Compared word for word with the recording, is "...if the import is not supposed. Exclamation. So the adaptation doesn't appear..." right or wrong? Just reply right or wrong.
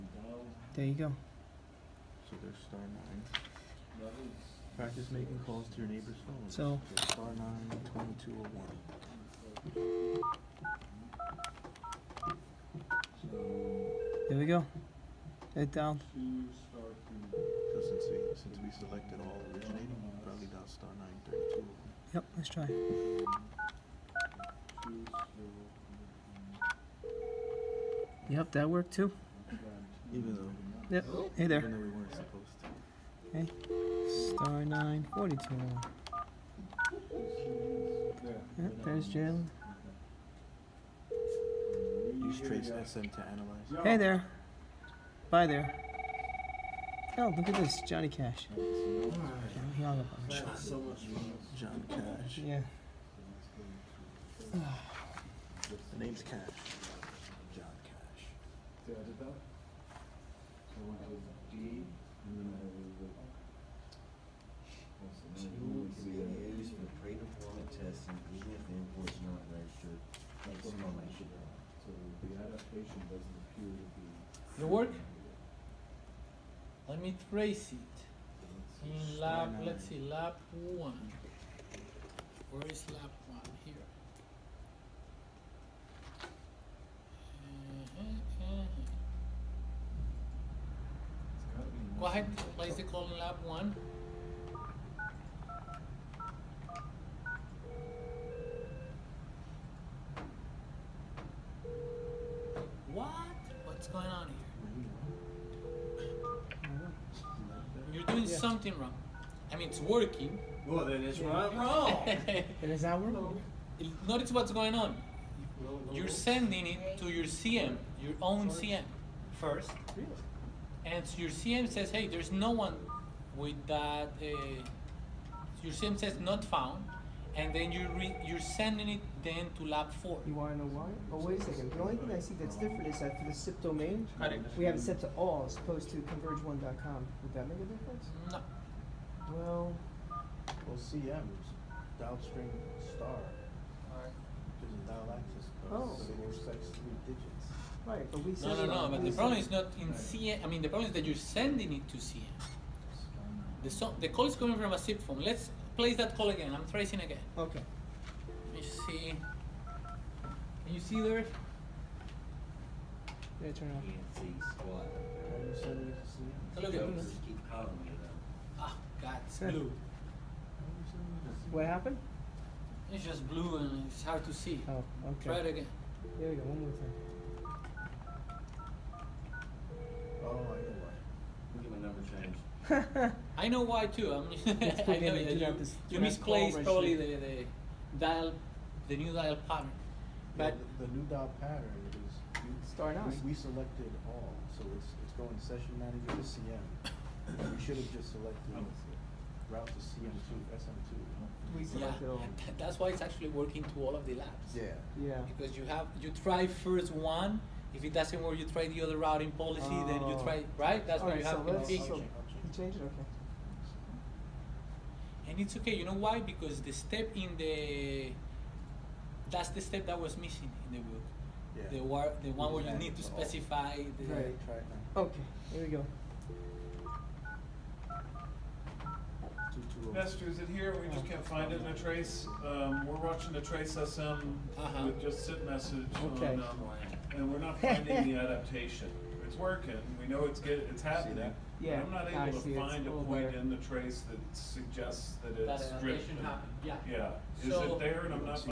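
wrong.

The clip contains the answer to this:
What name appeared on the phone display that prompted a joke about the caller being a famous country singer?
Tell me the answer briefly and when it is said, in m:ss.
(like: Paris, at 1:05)
Johnny Cash, at 0:47.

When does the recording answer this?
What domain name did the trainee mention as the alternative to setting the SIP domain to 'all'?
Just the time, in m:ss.
2:15.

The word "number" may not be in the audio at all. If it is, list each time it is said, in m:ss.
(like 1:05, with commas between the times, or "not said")
3:02.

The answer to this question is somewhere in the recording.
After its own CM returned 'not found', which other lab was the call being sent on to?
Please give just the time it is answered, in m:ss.
2:09.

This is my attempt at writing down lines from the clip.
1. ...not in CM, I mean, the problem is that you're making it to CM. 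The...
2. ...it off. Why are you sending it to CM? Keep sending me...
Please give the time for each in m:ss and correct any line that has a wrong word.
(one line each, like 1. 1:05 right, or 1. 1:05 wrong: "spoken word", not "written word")
1. 2:29 wrong: "sending", not "making"
2. 2:43 wrong: "calling", not "sending".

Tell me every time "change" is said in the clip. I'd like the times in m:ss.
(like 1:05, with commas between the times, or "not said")
3:03, 3:32.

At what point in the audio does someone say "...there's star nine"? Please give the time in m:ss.
0:02.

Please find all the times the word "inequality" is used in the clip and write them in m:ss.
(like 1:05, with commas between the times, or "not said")
not said.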